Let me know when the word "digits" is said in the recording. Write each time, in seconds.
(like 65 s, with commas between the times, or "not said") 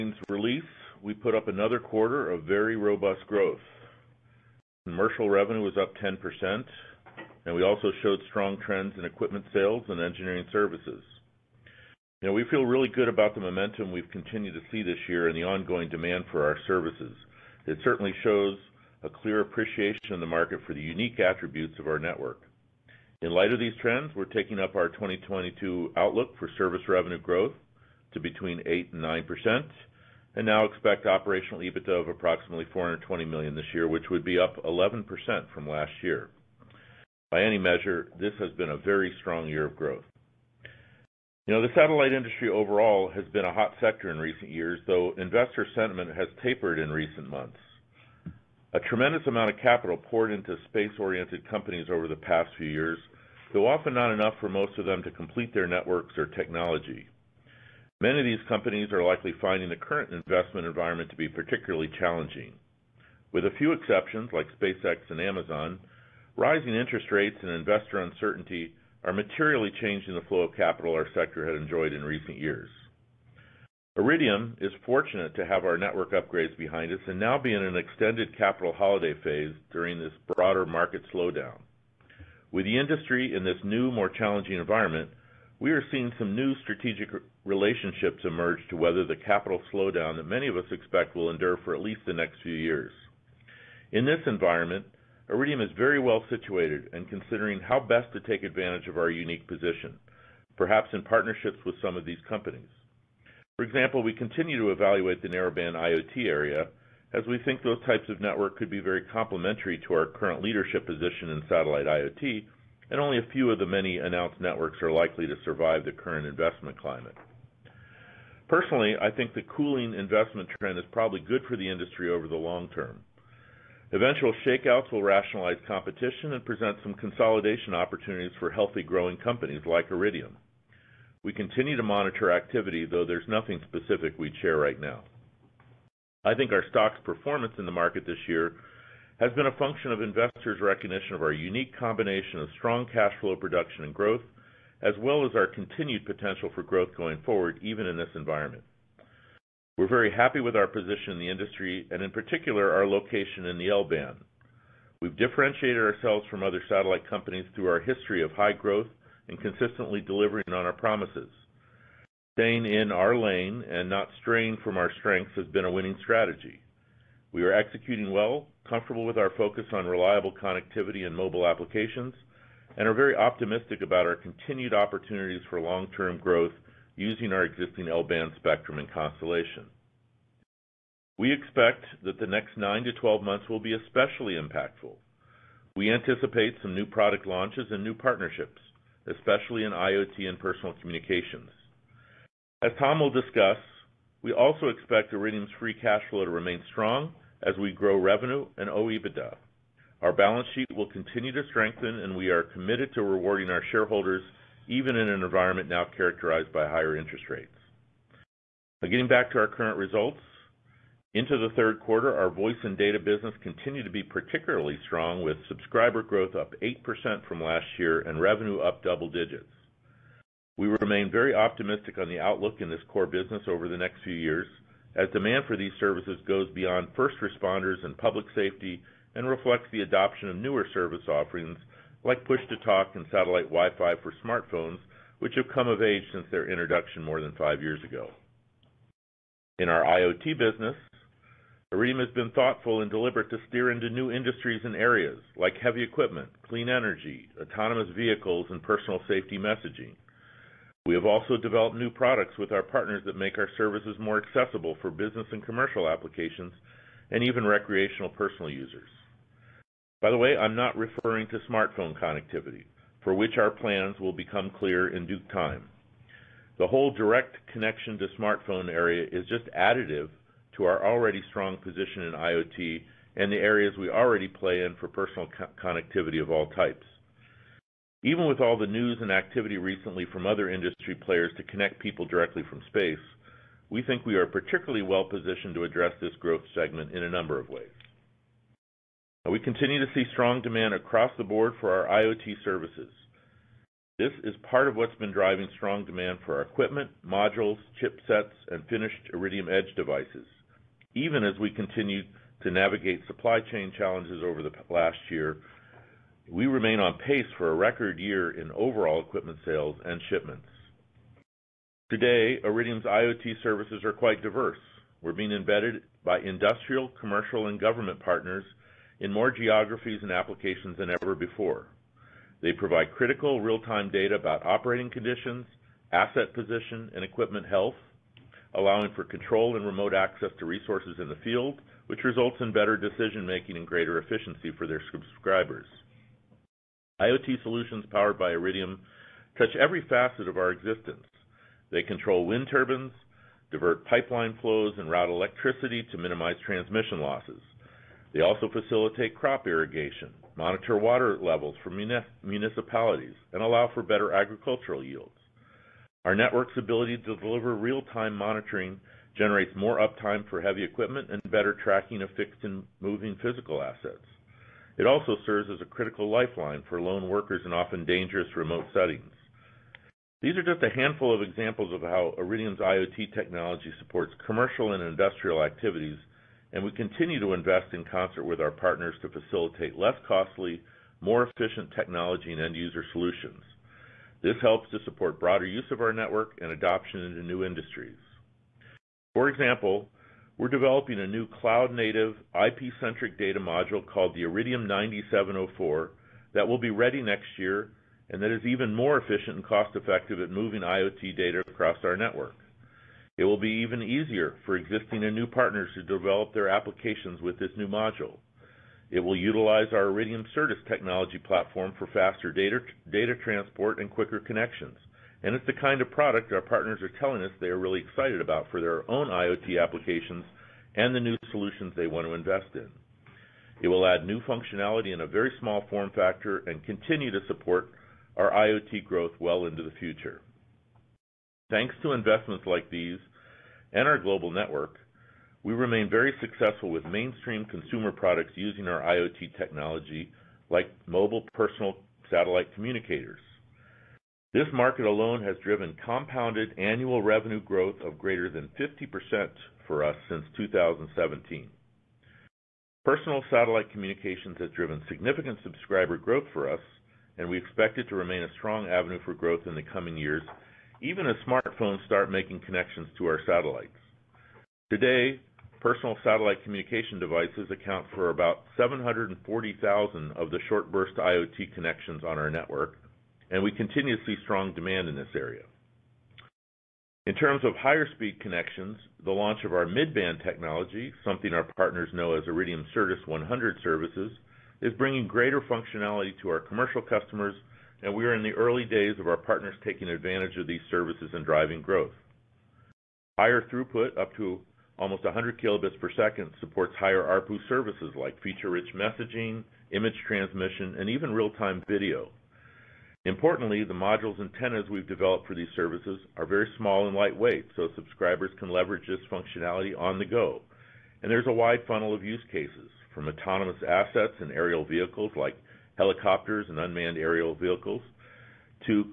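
219 s.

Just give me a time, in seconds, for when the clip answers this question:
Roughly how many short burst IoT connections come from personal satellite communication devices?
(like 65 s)
468 s.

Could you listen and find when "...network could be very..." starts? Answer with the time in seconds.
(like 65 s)
108 s.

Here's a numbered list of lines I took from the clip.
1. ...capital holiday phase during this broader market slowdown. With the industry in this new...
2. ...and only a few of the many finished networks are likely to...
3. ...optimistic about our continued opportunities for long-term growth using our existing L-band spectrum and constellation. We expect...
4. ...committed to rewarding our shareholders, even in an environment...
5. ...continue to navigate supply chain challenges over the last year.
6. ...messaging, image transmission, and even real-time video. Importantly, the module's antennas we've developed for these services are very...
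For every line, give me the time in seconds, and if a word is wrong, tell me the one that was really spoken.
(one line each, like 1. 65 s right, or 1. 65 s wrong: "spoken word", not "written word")
1. 78 s right
2. 112 s wrong: "announced", not "finished"
3. 173 s right
4. 202 s right
5. 301 s right
6. 498 s right.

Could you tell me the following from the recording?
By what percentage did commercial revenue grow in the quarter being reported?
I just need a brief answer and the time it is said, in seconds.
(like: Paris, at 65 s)
10%, at 5 s.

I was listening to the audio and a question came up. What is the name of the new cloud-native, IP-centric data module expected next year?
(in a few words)
Iridium 9704.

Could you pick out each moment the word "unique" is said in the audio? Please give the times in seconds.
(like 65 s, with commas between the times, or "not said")
20 s, 99 s, 141 s.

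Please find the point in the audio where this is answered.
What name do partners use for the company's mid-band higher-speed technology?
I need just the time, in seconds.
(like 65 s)
482 s.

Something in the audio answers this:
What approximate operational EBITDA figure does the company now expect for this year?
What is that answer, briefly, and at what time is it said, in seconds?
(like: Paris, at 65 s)
$420 million, at 32 s.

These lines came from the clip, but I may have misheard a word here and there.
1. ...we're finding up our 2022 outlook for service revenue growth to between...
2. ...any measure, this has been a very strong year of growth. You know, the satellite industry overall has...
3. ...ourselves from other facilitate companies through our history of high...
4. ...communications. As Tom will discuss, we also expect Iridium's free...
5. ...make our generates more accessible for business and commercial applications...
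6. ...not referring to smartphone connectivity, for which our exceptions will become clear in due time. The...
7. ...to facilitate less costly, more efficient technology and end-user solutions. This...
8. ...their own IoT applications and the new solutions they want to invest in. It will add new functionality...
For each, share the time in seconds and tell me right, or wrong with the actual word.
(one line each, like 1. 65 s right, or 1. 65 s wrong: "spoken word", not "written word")
1. 24 s wrong: "taking", not "finding"
2. 37 s right
3. 155 s wrong: "satellite", not "facilitate"
4. 190 s right
5. 253 s wrong: "services", not "generates"
6. 260 s wrong: "plans", not "exceptions"
7. 379 s right
8. 418 s right.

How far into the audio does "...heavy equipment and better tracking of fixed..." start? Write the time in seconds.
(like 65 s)
360 s.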